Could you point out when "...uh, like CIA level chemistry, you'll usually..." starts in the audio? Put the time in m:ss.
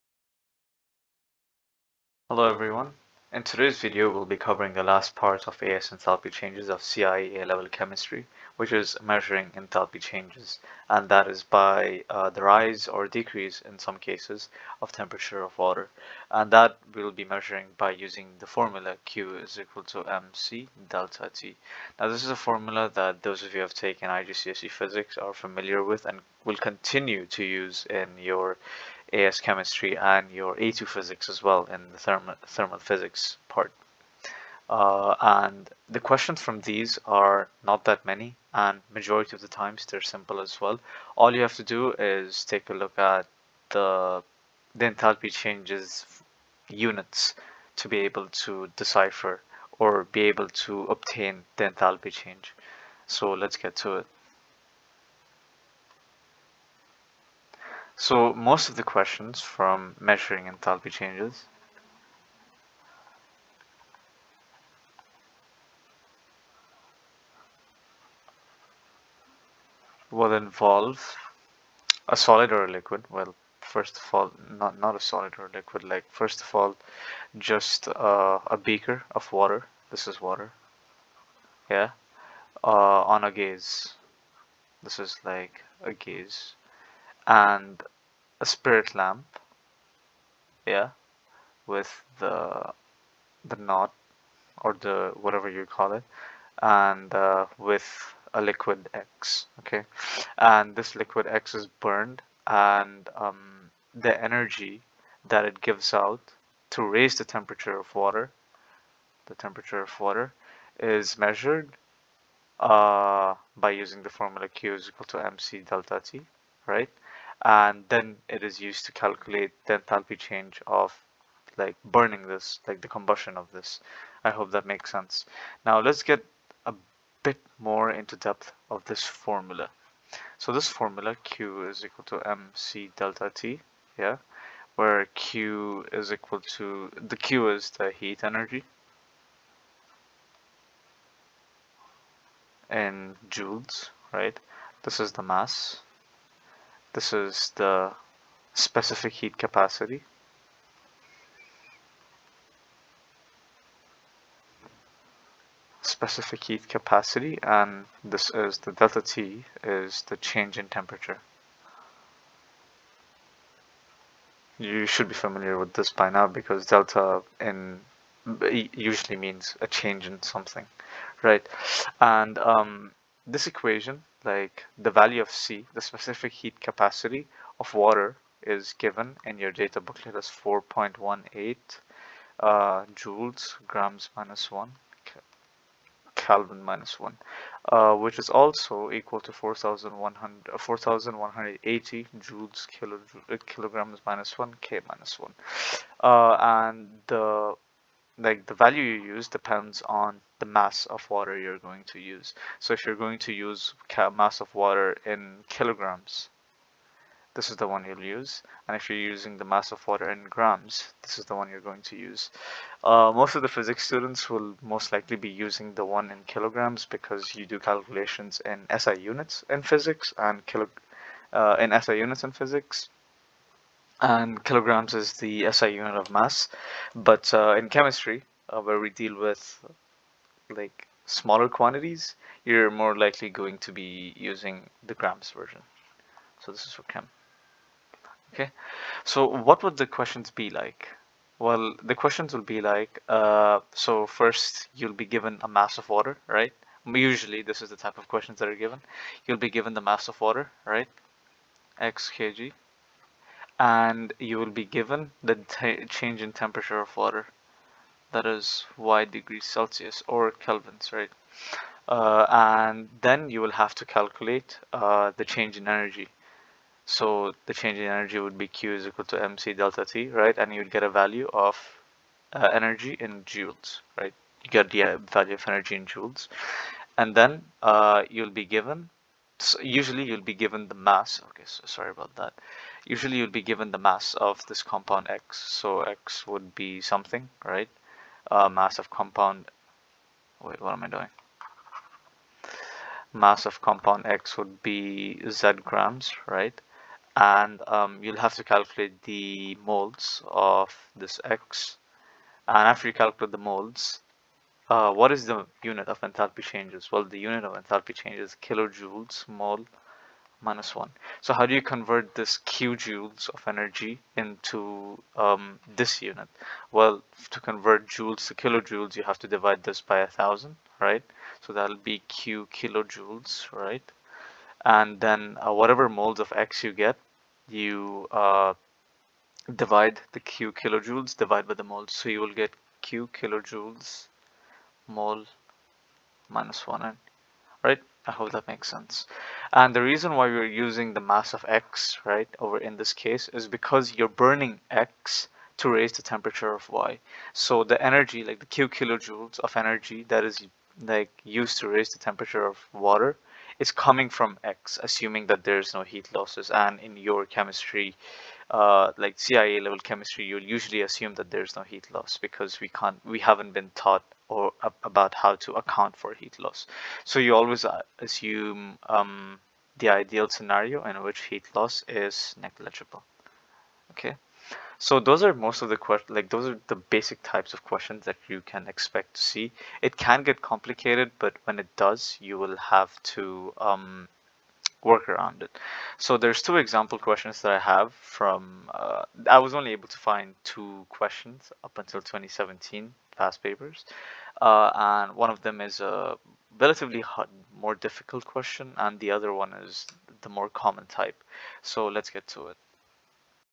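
5:58.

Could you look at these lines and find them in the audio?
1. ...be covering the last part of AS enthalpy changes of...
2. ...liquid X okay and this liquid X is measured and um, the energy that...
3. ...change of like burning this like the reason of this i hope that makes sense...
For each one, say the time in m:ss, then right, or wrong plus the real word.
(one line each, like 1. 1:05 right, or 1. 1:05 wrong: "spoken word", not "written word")
1. 0:04 right
2. 1:38 wrong: "burned", not "measured"
3. 2:00 wrong: "combustion", not "reason".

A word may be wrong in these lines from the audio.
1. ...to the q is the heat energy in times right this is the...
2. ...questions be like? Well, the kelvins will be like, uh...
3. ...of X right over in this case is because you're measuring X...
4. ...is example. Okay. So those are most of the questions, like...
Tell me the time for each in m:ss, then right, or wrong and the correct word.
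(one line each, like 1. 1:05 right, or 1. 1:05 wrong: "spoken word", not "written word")
1. 2:16 wrong: "joules", not "times"
2. 3:59 wrong: "questions", not "kelvins"
3. 5:41 wrong: "burning", not "measuring"
4. 6:11 wrong: "negligible", not "example".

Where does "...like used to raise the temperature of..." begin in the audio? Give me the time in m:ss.
5:50.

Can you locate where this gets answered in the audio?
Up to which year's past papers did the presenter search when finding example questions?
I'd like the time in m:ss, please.
6:32.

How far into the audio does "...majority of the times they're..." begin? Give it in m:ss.
0:38.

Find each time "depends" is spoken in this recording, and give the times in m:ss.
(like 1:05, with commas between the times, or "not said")
3:19.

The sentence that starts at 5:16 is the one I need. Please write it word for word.
Well, to convert joules to kilojoules, you have to divide this by a 1000, right?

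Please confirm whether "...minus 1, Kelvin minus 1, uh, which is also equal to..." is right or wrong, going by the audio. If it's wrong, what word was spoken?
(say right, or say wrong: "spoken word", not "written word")
right.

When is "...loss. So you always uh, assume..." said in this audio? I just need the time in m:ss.
6:06.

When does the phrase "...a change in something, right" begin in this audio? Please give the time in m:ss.
2:49.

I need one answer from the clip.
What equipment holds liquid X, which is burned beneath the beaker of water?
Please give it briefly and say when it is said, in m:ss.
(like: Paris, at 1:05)
spirit lamp, at 1:28.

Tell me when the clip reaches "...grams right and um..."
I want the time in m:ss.
4:55.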